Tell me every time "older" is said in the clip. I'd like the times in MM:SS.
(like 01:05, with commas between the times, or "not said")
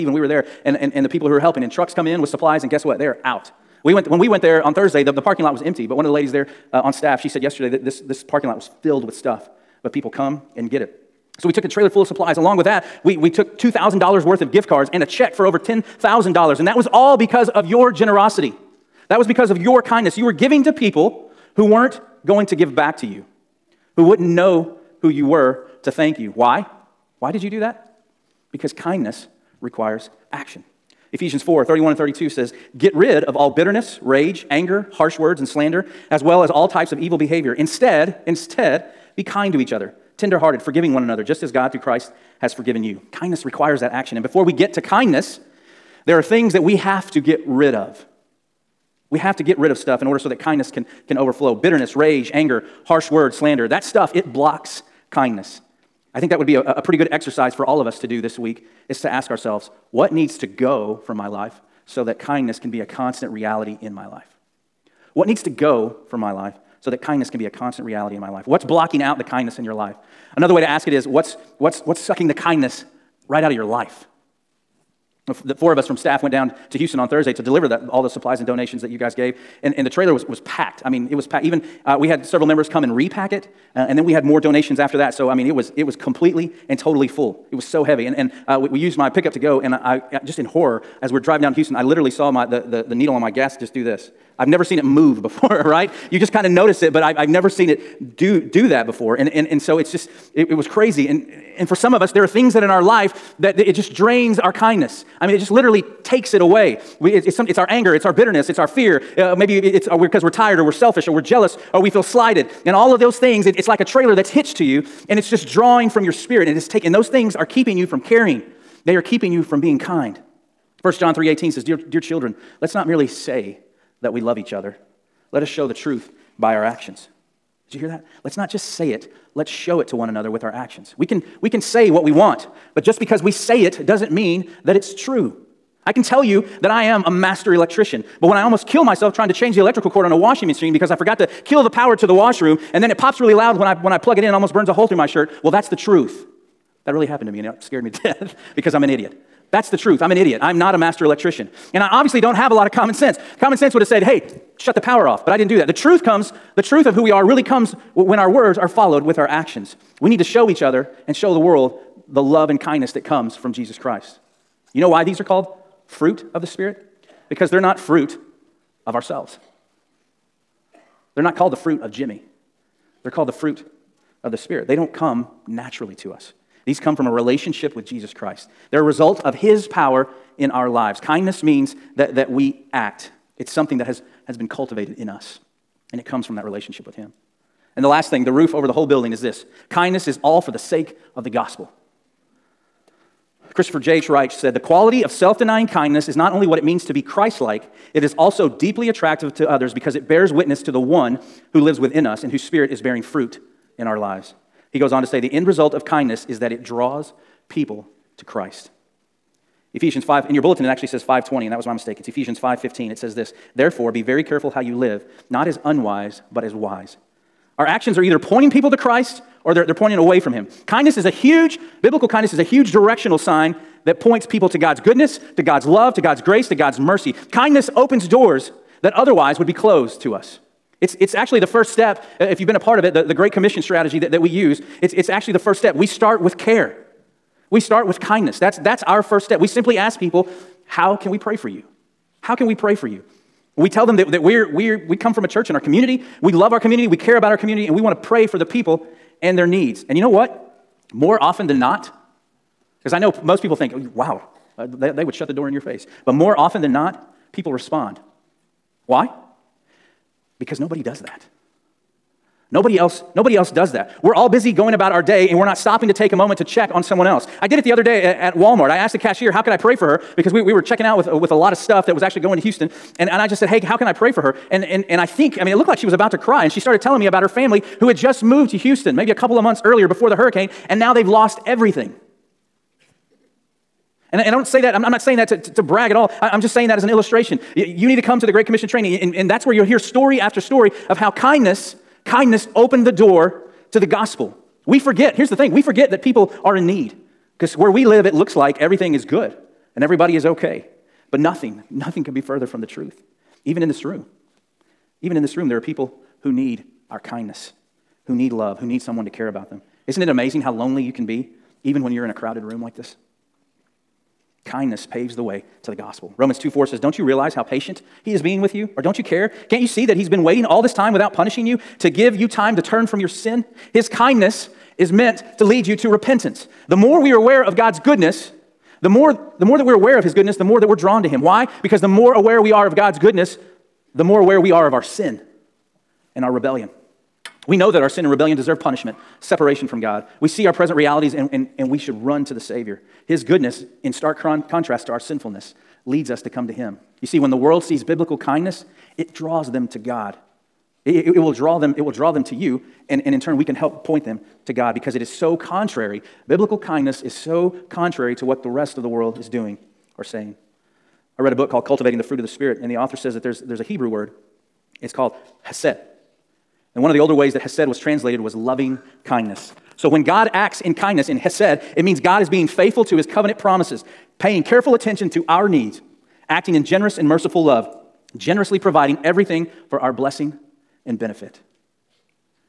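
06:07.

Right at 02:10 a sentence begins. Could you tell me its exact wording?
We can, we can say what we want, but just because we say it doesn't mean that it's true.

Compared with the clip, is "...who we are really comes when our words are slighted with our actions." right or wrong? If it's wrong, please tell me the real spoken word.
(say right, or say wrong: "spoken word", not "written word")
wrong: "followed", not "slighted".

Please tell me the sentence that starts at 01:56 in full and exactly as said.
And, it is taking those things are keeping you from caring, they are keeping you from being kind.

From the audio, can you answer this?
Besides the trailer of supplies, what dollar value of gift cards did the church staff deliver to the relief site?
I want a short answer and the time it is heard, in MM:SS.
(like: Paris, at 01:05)
$2,000, at 00:13.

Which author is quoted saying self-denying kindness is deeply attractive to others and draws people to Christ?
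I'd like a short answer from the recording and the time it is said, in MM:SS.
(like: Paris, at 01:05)
Christopher J.H. Wright, at 03:13.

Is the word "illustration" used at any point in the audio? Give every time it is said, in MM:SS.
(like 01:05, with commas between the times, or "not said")
04:46.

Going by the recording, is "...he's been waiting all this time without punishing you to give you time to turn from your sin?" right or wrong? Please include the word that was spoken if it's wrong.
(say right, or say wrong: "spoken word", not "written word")
right.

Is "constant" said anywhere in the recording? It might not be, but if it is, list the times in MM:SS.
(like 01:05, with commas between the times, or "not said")
01:02, 01:07.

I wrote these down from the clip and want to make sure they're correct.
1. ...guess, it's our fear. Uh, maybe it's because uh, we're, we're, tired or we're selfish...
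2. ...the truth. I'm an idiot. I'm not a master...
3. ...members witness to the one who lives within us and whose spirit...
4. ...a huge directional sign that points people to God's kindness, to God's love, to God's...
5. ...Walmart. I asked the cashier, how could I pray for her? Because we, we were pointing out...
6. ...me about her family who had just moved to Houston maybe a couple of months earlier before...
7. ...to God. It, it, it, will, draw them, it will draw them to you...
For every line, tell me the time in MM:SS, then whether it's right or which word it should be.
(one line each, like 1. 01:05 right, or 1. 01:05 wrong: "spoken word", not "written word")
1. 01:48 wrong: "bitterness", not "guess"
2. 02:29 right
3. 03:20 wrong: "bears", not "members"
4. 03:42 wrong: "goodness", not "kindness"
5. 04:28 wrong: "checking", not "pointing"
6. 04:36 right
7. 05:49 right.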